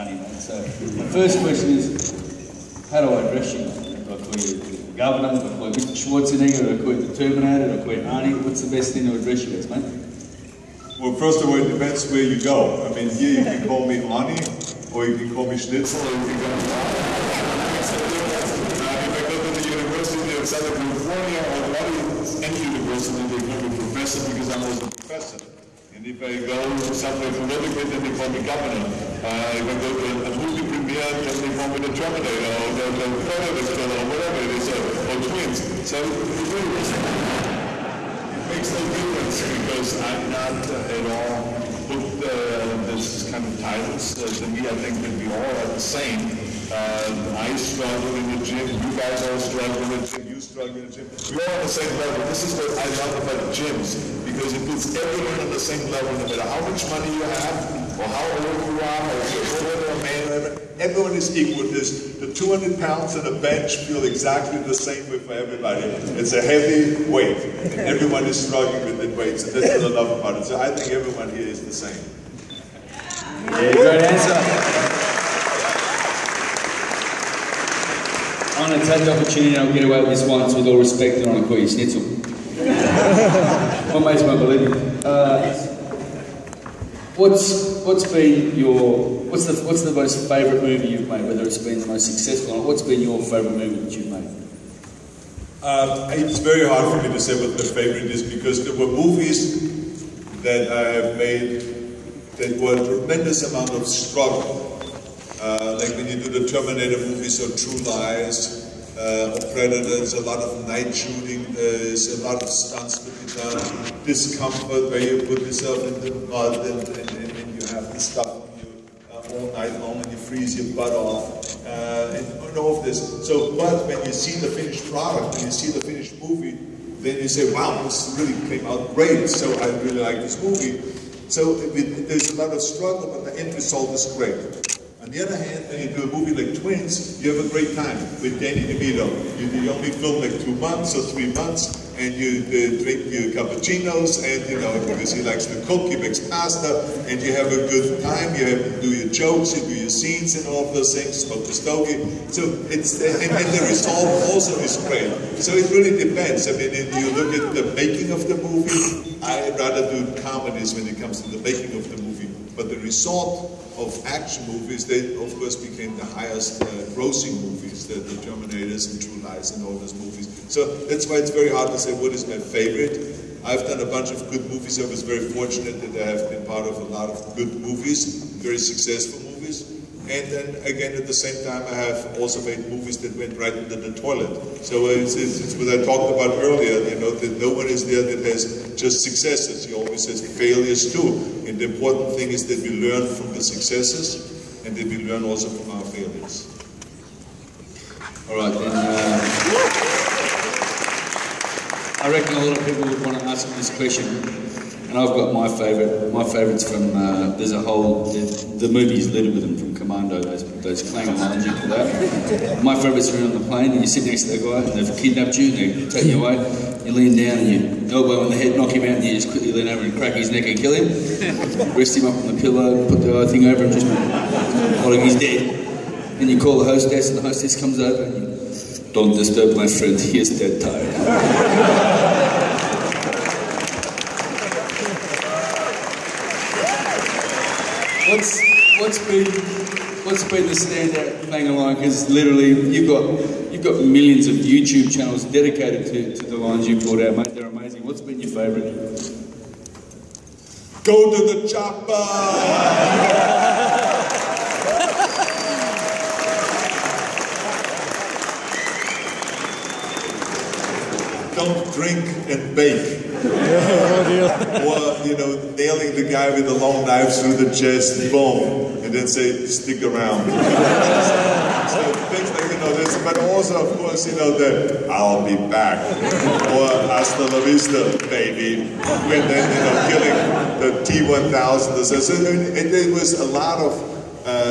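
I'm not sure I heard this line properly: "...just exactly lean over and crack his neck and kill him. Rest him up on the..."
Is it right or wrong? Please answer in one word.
wrong.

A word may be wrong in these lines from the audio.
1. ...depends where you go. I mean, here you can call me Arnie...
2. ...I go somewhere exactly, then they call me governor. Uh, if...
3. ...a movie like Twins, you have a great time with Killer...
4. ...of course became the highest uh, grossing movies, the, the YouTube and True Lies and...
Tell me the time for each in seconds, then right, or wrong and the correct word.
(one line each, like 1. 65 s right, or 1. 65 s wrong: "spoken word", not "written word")
1. 11 s right
2. 26 s wrong: "politically", not "exactly"
3. 136 s wrong: "Danny", not "Killer"
4. 165 s wrong: "Terminators", not "YouTube".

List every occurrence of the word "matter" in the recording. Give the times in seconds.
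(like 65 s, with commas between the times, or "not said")
36 s, 56 s.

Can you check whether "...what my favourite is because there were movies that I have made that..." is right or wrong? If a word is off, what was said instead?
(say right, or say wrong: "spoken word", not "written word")
right.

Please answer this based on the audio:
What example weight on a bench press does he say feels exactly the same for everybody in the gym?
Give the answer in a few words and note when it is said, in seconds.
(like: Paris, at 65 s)
200 pounds, at 62 s.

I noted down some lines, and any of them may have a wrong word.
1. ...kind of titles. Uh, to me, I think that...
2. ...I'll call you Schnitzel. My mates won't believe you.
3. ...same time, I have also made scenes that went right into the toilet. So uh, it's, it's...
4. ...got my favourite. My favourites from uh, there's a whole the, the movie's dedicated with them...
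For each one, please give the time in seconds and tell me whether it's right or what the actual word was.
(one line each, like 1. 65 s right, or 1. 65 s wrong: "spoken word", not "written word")
1. 43 s right
2. 81 s right
3. 181 s wrong: "movies", not "scenes"
4. 205 s wrong: "littered", not "dedicated".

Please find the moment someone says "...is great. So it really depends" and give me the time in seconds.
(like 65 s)
154 s.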